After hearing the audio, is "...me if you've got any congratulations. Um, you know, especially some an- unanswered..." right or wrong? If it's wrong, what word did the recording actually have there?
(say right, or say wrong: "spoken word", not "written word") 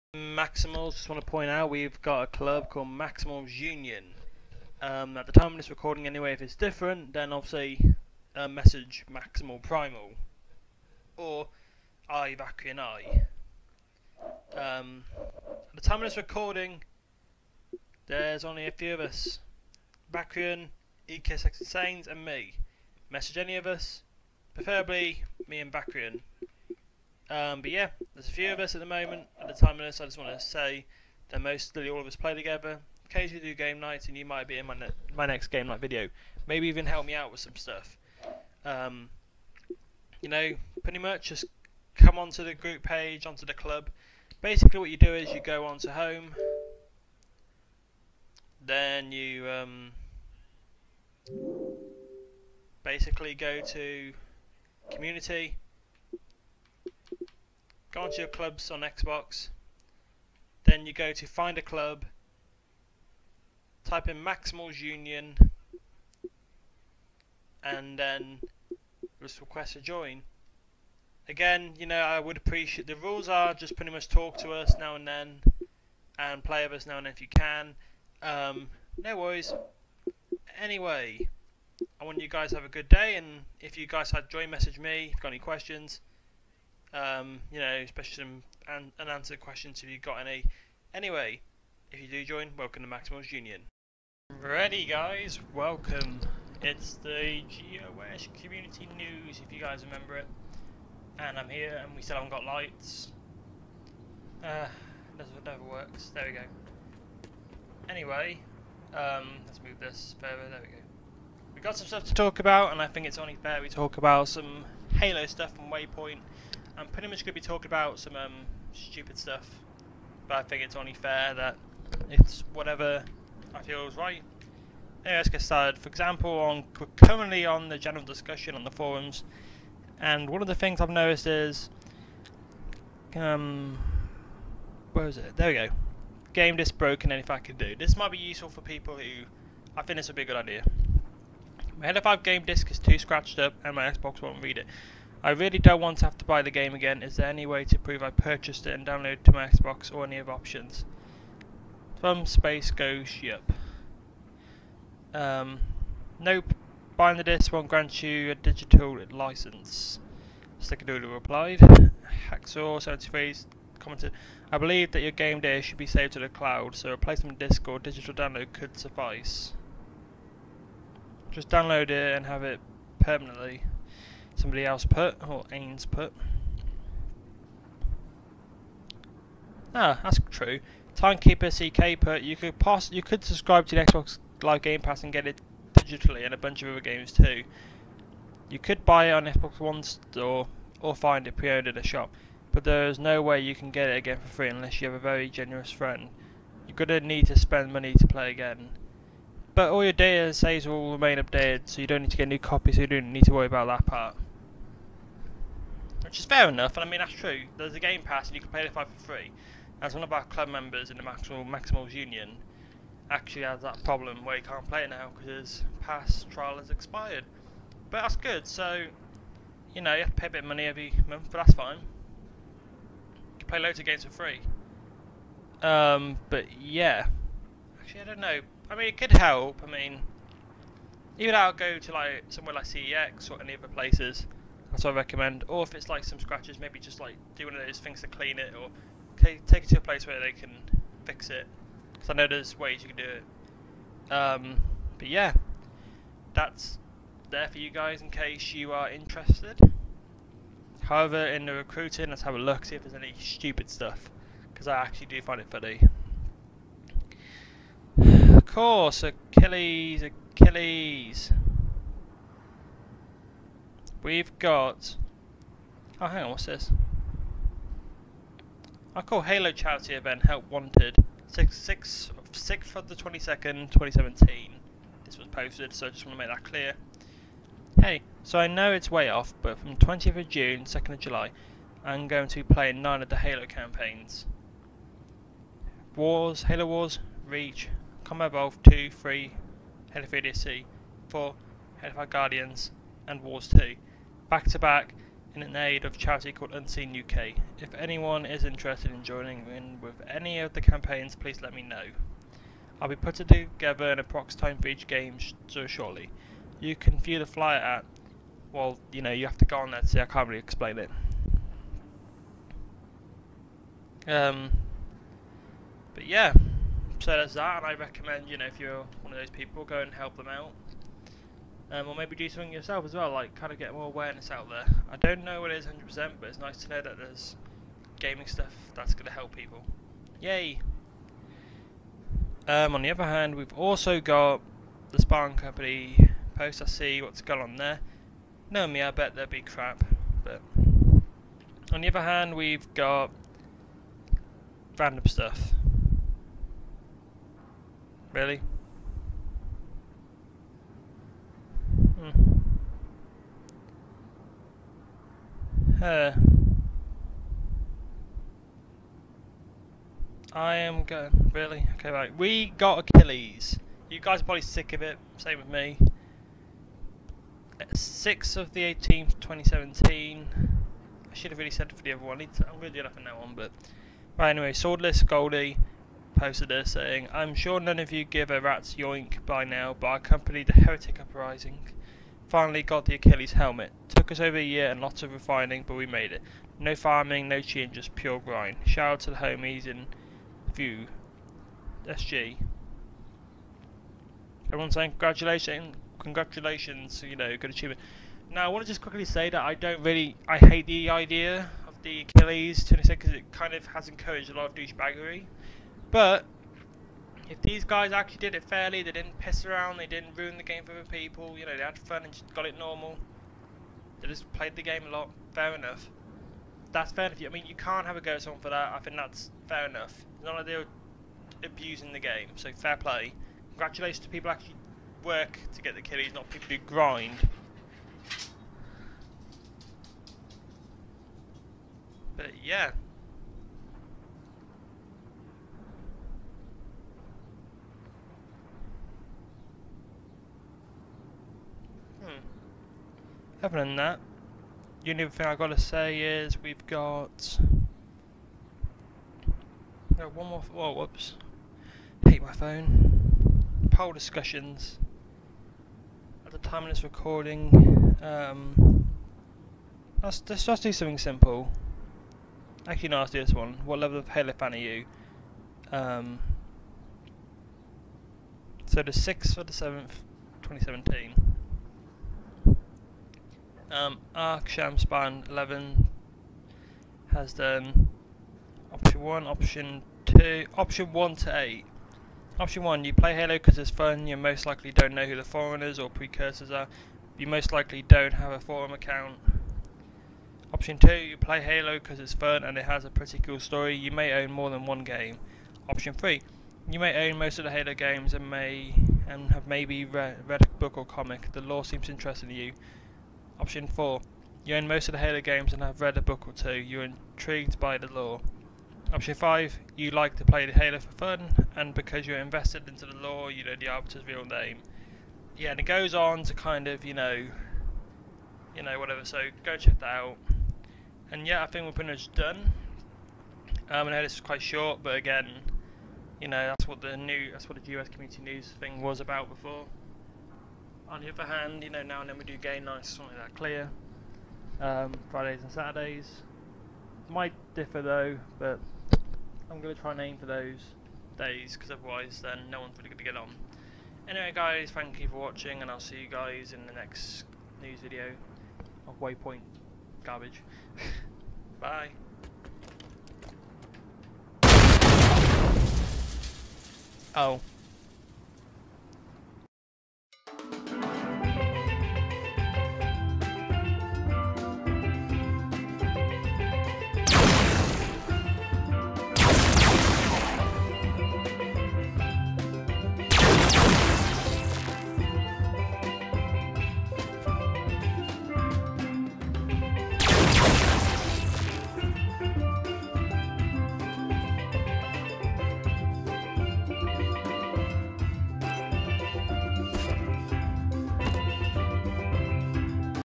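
wrong: "questions", not "congratulations".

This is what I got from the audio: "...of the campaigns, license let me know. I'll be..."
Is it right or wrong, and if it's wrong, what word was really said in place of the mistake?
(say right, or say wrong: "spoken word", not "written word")
wrong: "please", not "license".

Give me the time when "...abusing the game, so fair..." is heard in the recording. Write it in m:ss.
7:01.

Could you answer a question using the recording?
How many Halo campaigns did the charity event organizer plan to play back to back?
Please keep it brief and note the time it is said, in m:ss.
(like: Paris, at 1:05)
9, at 4:42.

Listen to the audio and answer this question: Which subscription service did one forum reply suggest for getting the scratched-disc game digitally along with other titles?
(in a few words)
Xbox Live Game Pass.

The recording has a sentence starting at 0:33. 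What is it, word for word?
Occasionally do game nights, and you might be in my, ne my next game night video.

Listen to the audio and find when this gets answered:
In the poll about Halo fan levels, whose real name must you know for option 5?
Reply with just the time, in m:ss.
8:33.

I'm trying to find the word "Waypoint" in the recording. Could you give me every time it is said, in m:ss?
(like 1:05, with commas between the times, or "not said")
1:55, 9:09.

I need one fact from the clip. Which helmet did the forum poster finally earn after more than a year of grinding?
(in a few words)
Achilles helmet.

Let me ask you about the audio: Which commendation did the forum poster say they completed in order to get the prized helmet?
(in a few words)
Heretic Uprising.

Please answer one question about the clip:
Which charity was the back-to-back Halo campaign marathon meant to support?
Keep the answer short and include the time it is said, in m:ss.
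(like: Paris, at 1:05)
Unseen UK, at 4:56.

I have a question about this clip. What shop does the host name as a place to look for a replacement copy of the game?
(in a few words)
CEX.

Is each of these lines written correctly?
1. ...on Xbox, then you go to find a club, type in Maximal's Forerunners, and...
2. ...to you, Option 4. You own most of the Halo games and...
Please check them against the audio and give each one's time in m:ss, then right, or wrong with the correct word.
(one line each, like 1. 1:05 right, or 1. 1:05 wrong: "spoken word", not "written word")
1. 0:58 wrong: "Union", not "Forerunners"
2. 8:22 right.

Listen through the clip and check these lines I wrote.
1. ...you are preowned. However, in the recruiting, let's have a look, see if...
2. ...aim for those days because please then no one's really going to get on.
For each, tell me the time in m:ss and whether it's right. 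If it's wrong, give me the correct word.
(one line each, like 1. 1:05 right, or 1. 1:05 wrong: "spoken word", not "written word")
1. 4:08 wrong: "interested", not "preowned"
2. 9:00 wrong: "otherwise", not "please".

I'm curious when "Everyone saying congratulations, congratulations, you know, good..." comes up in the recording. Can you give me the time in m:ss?
6:34.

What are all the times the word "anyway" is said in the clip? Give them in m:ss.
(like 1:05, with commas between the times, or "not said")
0:06, 1:20, 1:30, 1:47, 2:05, 6:14, 9:04.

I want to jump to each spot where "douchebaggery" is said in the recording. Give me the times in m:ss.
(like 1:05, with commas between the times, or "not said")
6:44.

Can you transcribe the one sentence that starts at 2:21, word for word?
My Halo 5 game disc is too scratched up, and my Xbox won't read it.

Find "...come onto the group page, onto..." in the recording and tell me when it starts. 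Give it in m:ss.
0:41.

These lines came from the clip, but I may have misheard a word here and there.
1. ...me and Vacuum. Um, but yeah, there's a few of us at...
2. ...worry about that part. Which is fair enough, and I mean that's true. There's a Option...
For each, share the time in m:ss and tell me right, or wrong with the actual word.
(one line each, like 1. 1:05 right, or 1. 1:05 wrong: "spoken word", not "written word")
1. 0:25 right
2. 3:23 wrong: "Game", not "Option".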